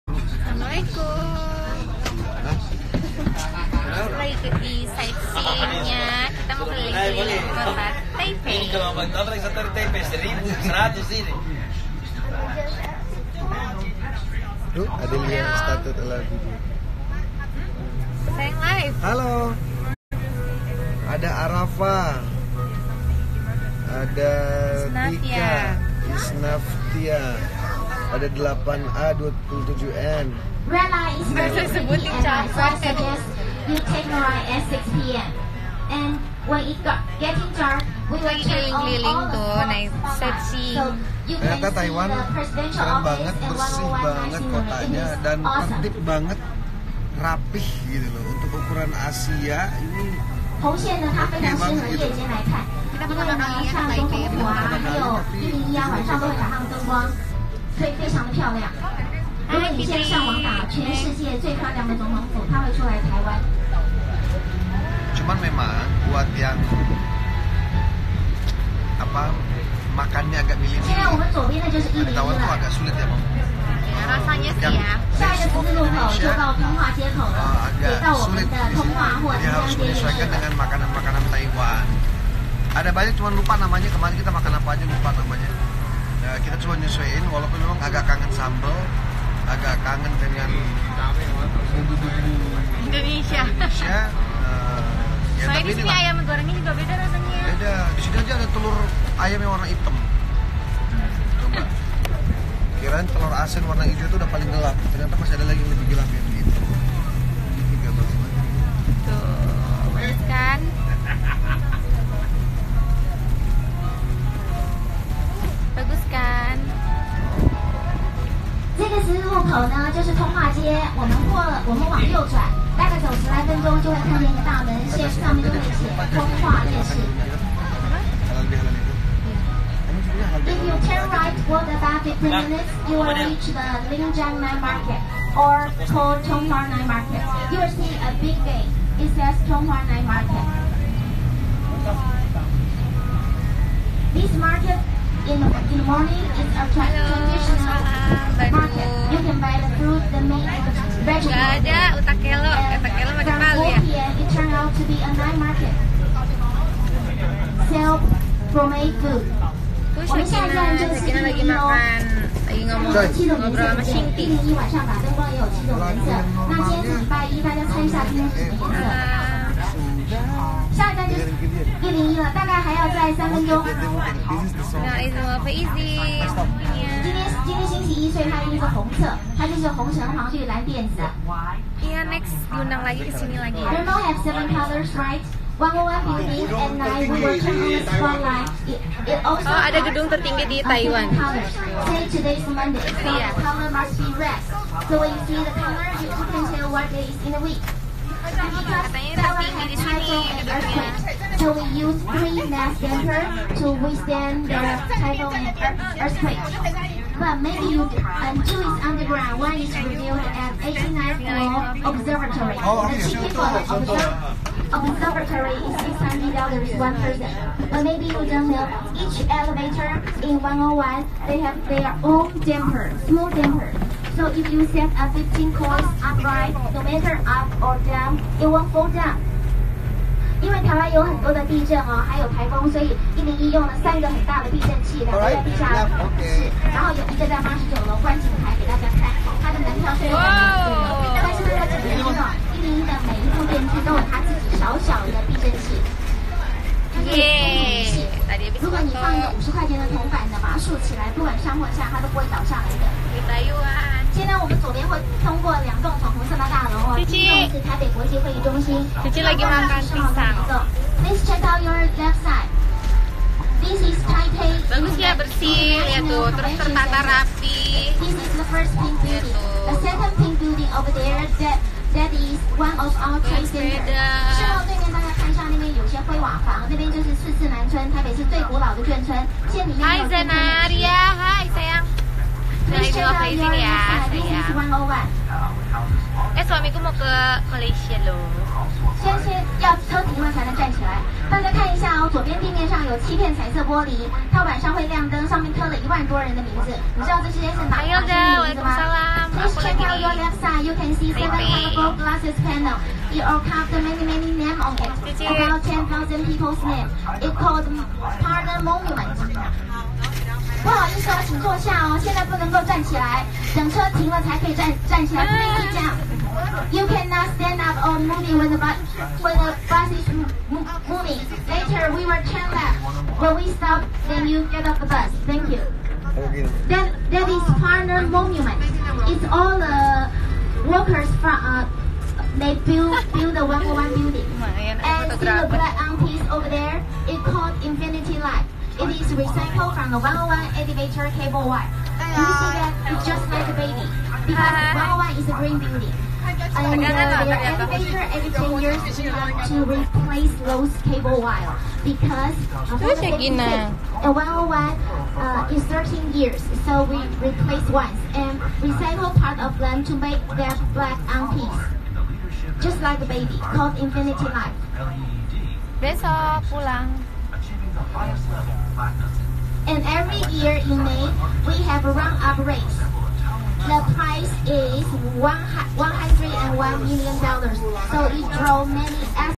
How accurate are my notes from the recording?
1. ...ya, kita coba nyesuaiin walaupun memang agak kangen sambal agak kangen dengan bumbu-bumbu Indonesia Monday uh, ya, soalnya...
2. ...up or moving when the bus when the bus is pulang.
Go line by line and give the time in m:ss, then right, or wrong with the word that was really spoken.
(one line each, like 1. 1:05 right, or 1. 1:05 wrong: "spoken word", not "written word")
1. 1:26 wrong: "Indonesia", not "Monday"
2. 5:17 wrong: "moving", not "pulang".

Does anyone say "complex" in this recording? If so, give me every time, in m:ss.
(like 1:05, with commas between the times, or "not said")
not said.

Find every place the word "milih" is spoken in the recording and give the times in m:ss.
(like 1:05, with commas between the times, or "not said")
1:10.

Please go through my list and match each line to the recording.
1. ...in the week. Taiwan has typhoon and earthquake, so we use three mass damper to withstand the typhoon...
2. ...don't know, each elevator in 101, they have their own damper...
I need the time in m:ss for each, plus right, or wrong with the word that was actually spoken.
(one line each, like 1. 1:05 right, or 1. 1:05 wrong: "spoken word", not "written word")
1. 3:17 right
2. 3:38 right.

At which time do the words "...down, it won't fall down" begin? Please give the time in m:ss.
3:47.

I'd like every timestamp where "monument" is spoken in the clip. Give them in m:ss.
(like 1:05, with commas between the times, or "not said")
5:08, 5:28.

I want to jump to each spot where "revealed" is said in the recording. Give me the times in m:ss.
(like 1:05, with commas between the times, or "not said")
3:29.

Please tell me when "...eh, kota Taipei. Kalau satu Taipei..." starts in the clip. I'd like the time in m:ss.
0:07.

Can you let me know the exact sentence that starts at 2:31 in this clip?
Gak ada utak kelo utak kelo pakai palu ya food Terus Shakina, Shakina lagi makan, lagi ngomong, ngobrol sama Shinti.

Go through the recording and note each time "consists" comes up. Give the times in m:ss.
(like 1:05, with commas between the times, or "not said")
not said.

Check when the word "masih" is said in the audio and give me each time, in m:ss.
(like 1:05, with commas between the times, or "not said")
1:45.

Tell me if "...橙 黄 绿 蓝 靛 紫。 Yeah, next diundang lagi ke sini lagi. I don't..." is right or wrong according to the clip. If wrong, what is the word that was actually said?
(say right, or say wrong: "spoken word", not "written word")
right.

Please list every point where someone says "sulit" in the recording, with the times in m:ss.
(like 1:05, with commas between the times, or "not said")
1:12, 1:18.